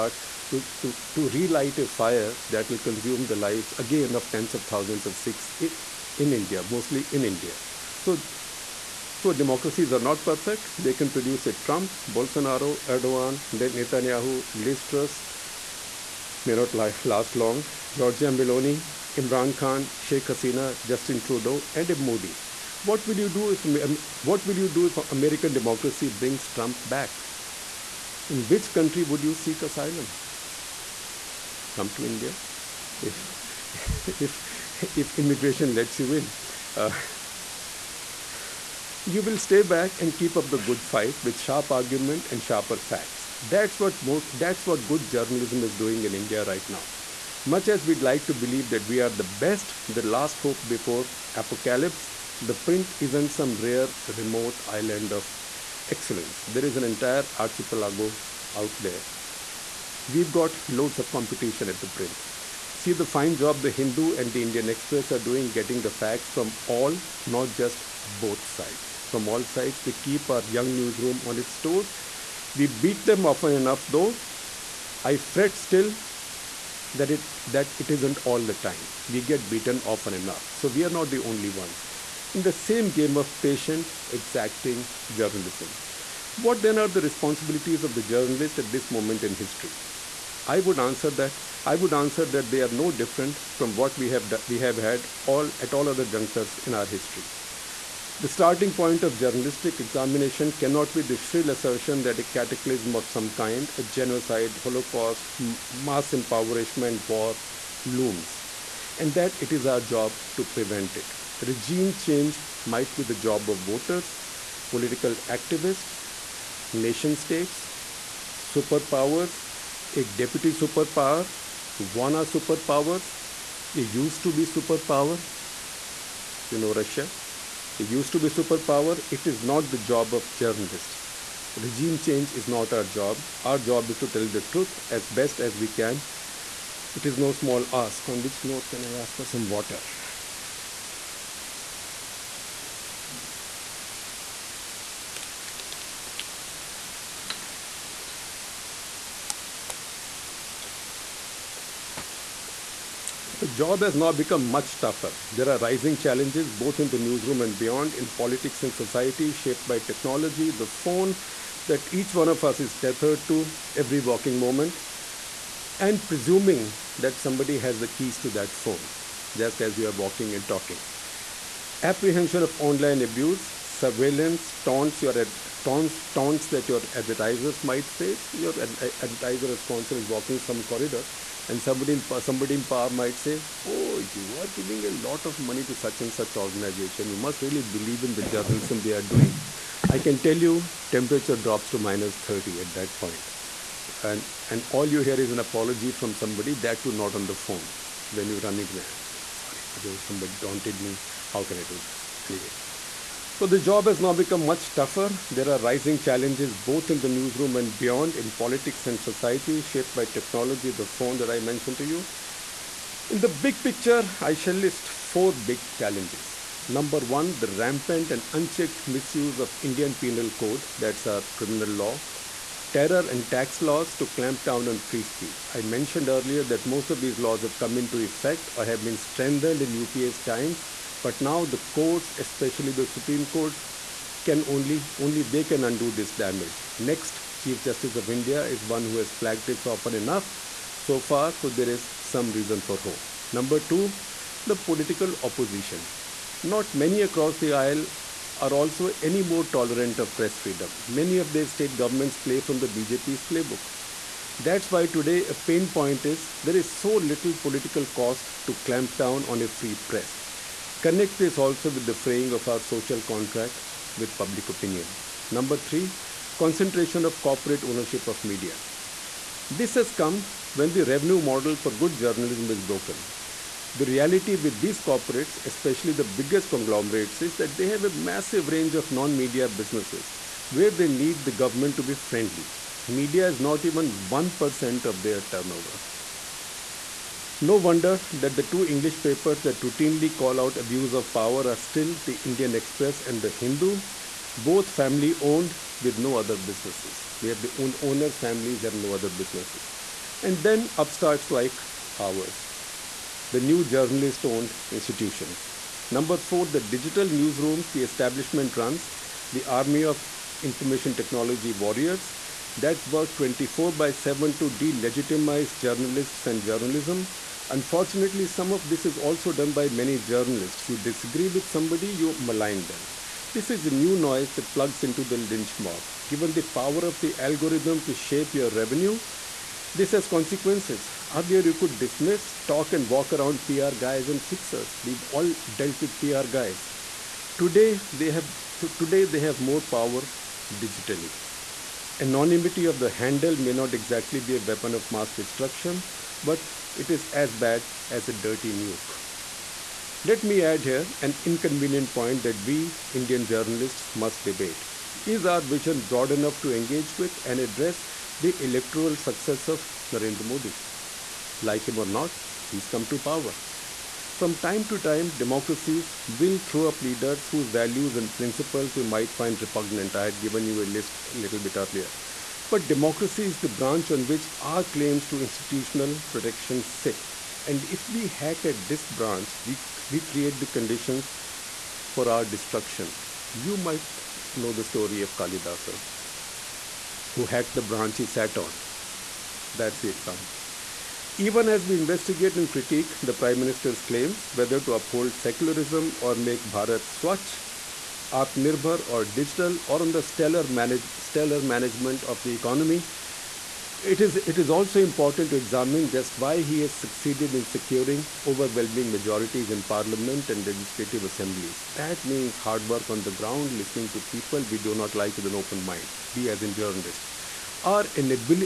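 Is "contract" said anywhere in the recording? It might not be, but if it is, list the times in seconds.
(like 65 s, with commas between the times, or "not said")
263 s.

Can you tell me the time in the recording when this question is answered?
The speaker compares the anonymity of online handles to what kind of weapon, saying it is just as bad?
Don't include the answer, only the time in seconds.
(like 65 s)
348 s.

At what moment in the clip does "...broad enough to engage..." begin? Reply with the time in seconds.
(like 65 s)
355 s.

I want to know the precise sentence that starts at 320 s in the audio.
You disagree with somebody, you malign them.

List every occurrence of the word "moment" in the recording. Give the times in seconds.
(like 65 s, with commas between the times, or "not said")
88 s, 164 s.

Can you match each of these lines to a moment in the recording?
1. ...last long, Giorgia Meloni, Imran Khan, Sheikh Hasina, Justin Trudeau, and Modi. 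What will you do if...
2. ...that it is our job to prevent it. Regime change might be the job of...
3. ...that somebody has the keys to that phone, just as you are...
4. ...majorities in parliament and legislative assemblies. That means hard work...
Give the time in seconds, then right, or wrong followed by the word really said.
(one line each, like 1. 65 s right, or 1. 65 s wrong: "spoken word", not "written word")
1. 17 s right
2. 109 s right
3. 166 s right
4. 408 s right.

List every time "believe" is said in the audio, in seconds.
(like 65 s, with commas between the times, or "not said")
48 s, 187 s.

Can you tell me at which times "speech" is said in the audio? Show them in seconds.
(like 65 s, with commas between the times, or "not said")
225 s.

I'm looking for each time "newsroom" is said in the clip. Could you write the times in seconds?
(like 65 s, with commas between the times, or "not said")
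70 s, 156 s, 207 s, 307 s.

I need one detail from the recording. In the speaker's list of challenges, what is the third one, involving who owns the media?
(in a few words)
Concentration of corporate ownership.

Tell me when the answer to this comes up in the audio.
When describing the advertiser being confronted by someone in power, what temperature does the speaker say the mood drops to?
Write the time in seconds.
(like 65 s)
191 s.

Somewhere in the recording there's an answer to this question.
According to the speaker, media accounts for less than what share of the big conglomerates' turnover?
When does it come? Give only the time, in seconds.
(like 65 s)
284 s.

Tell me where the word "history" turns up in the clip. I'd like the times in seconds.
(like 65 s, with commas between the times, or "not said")
89 s, 96 s.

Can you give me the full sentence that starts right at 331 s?
Earlier, you could dismiss, talk, and walk around PR guys and fixers.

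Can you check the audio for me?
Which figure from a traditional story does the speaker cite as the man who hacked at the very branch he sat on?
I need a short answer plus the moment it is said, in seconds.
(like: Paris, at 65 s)
Kalidasa, at 385 s.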